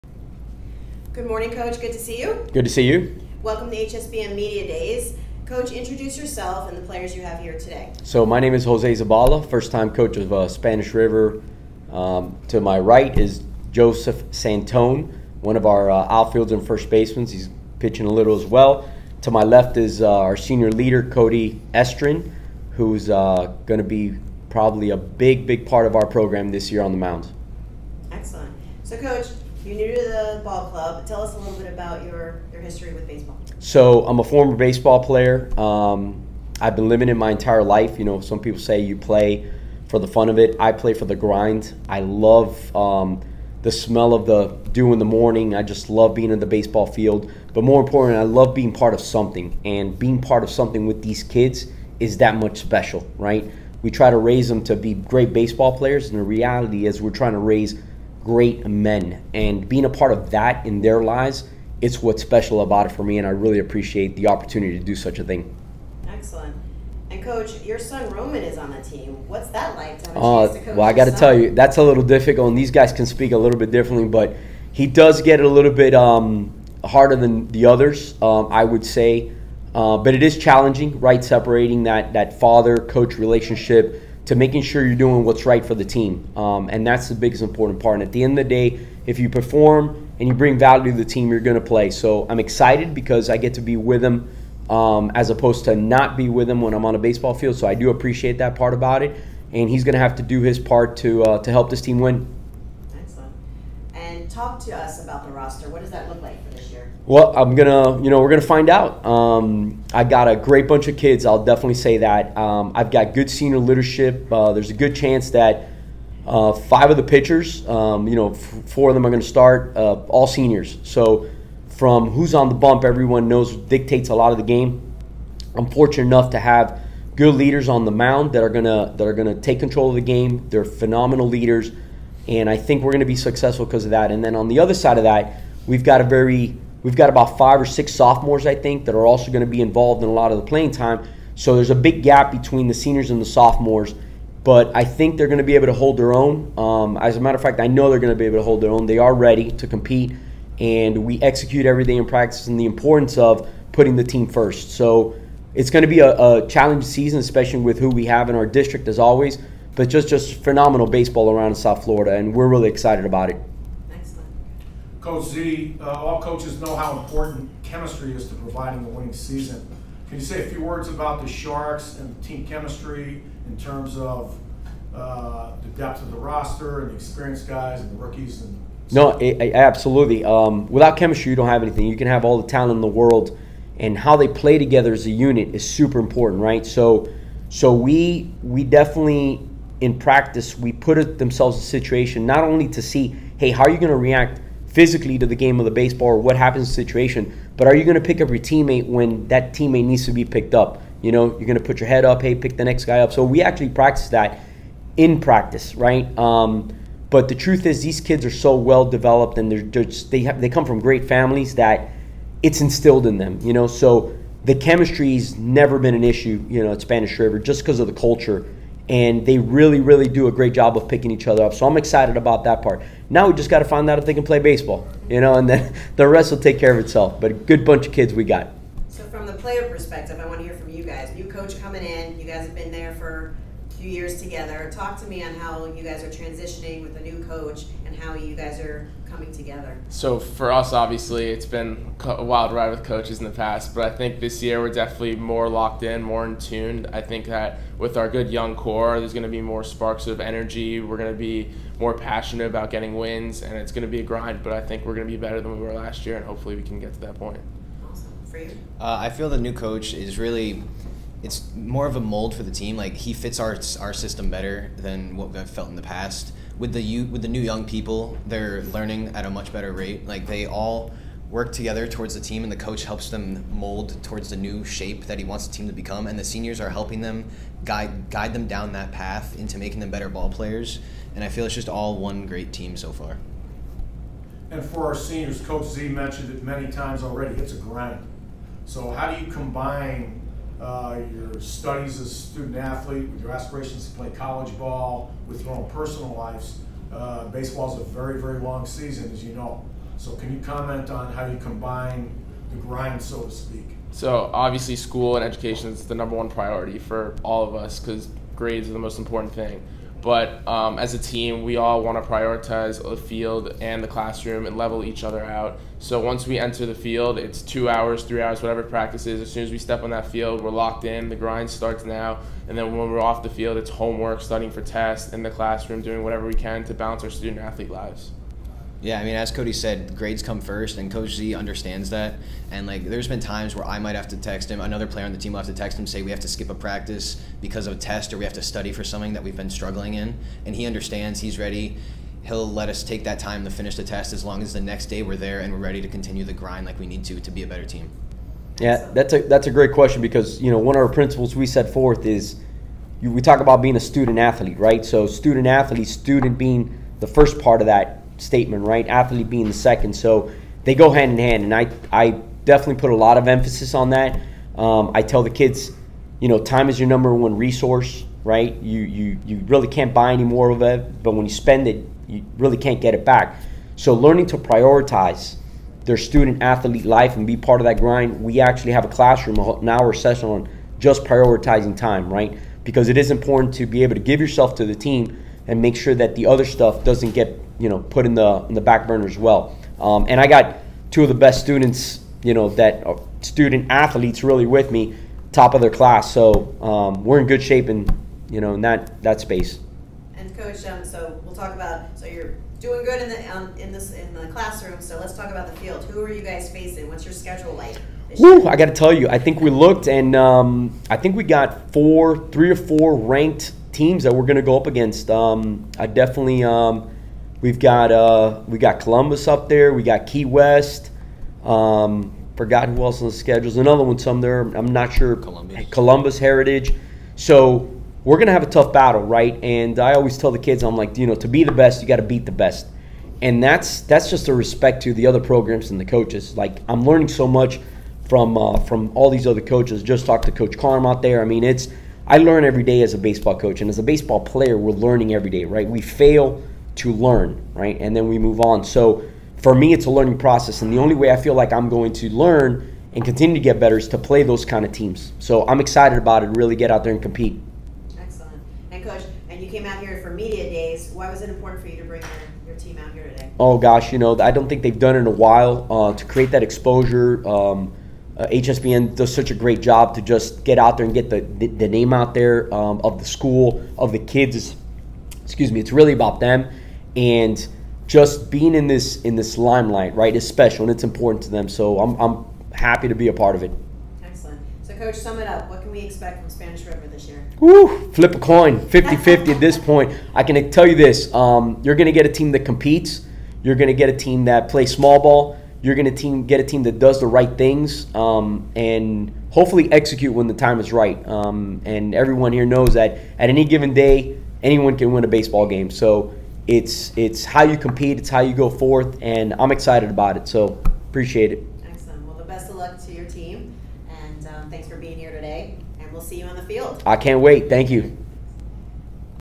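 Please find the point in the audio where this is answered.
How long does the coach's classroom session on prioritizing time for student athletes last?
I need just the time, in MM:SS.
06:19.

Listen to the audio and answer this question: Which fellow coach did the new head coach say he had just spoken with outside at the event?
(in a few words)
Coach Carm.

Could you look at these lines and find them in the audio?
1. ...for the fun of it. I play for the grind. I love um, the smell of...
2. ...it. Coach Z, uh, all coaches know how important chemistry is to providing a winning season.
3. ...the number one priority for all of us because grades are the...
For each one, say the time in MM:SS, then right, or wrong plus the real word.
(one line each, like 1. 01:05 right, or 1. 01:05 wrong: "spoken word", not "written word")
1. 00:39 right
2. 02:43 right
3. 05:05 right.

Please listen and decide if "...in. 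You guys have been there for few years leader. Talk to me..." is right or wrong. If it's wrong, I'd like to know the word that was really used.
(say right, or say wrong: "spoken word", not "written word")
wrong: "together", not "leader".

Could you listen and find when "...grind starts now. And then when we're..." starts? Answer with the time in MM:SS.
05:21.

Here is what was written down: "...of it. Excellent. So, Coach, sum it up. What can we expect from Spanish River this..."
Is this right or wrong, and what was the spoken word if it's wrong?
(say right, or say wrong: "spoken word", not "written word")
right.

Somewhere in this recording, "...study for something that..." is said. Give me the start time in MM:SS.
05:38.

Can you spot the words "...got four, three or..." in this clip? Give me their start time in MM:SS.
06:51.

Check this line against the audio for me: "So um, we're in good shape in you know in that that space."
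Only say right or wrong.
right.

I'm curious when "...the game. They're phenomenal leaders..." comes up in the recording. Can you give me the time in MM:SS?
02:09.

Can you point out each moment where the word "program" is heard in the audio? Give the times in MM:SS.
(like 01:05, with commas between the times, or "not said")
00:26, 07:15.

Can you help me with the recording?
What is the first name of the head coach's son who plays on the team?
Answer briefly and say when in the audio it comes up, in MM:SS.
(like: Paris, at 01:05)
Roman, at 01:08.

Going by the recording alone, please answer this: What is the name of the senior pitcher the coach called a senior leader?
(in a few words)
Cody Estrin.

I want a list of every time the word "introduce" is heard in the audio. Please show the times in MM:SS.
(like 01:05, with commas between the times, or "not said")
00:05.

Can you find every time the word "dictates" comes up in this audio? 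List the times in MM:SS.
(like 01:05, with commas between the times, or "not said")
02:03.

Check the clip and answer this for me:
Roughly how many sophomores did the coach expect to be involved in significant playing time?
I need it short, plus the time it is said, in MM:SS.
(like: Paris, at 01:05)
5 or 6, at 02:17.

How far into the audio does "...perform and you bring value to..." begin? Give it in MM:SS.
01:29.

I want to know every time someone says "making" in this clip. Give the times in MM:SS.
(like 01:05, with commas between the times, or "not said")
01:24, 04:39.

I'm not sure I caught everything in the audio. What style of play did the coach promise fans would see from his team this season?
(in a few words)
small ball.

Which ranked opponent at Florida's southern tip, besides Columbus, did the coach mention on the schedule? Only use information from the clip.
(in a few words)
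Key West.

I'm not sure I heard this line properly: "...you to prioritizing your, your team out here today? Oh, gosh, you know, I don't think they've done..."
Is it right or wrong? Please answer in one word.
wrong.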